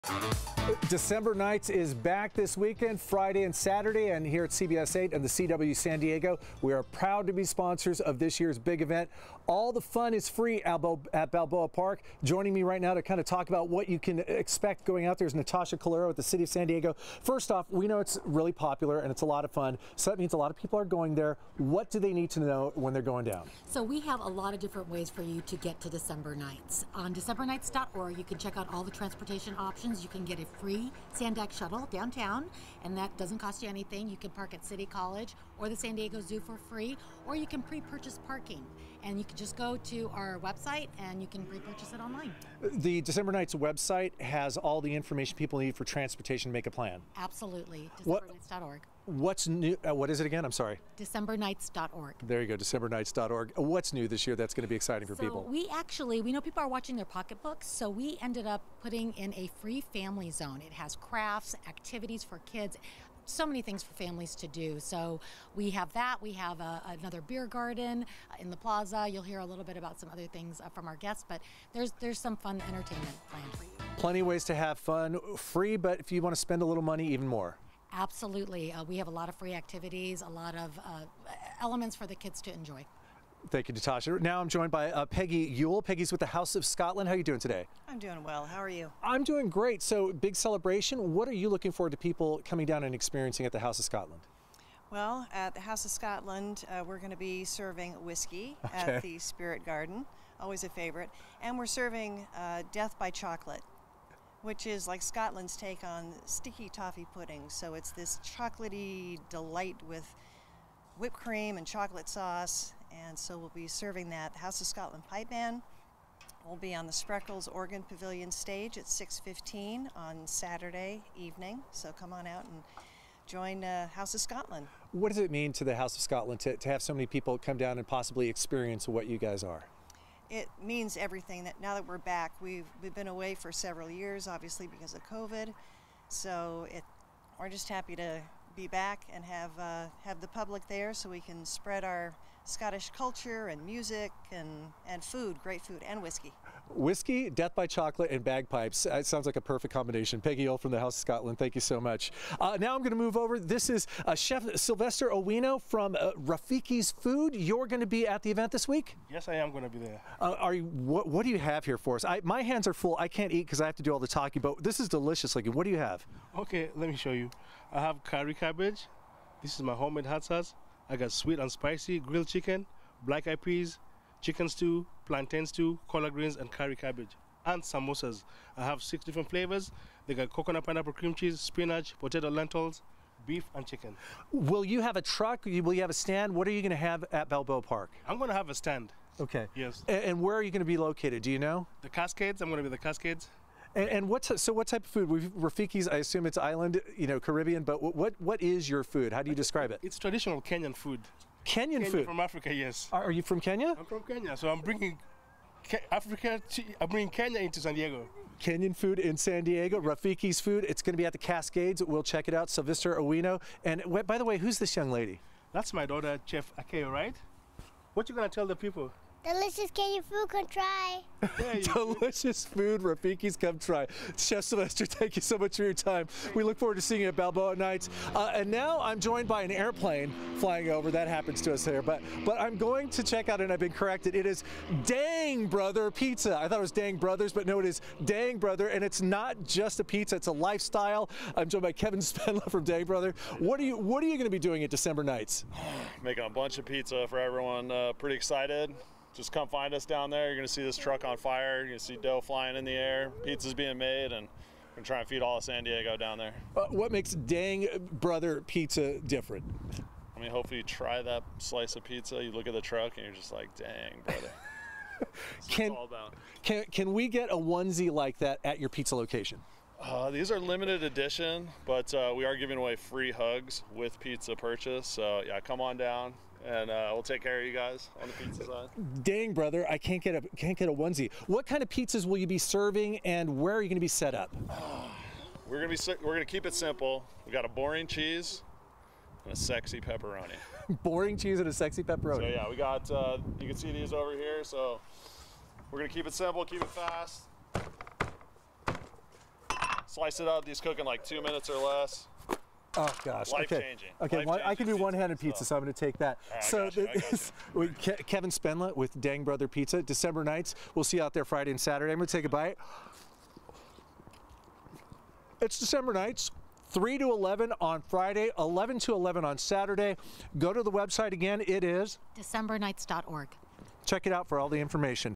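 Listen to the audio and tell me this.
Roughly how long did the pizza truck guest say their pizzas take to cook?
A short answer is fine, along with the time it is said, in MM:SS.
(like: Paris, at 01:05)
2 minutes or less, at 05:01.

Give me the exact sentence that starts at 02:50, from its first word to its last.
I got sweet and spicy grilled chicken, black eyed peas, chicken stew, plantain stew, collard greens, and curry cabbage.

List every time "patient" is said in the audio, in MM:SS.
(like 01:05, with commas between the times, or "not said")
not said.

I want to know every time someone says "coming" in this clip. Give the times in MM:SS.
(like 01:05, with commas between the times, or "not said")
01:32.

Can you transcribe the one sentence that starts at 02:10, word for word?
It means everything that now that we're back, we've, we've been away for several years, obviously because of COVID.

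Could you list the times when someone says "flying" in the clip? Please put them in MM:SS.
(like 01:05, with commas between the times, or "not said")
03:50, 04:12.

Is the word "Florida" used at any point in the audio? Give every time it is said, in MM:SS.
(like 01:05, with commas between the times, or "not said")
not said.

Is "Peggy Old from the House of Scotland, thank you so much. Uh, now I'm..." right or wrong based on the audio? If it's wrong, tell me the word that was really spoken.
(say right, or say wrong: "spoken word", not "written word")
right.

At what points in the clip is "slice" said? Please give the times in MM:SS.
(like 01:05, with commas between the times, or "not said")
04:21, 04:59.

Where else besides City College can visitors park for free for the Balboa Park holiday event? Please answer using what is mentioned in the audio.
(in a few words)
San Diego Zoo.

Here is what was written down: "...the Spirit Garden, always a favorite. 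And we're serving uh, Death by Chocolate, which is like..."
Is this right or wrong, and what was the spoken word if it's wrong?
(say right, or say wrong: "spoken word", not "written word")
right.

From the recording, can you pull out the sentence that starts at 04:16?
Uh, what makes Dang Brother Pizza different?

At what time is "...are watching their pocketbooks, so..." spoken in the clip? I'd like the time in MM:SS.
00:56.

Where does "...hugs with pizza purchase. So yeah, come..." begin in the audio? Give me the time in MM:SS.
04:33.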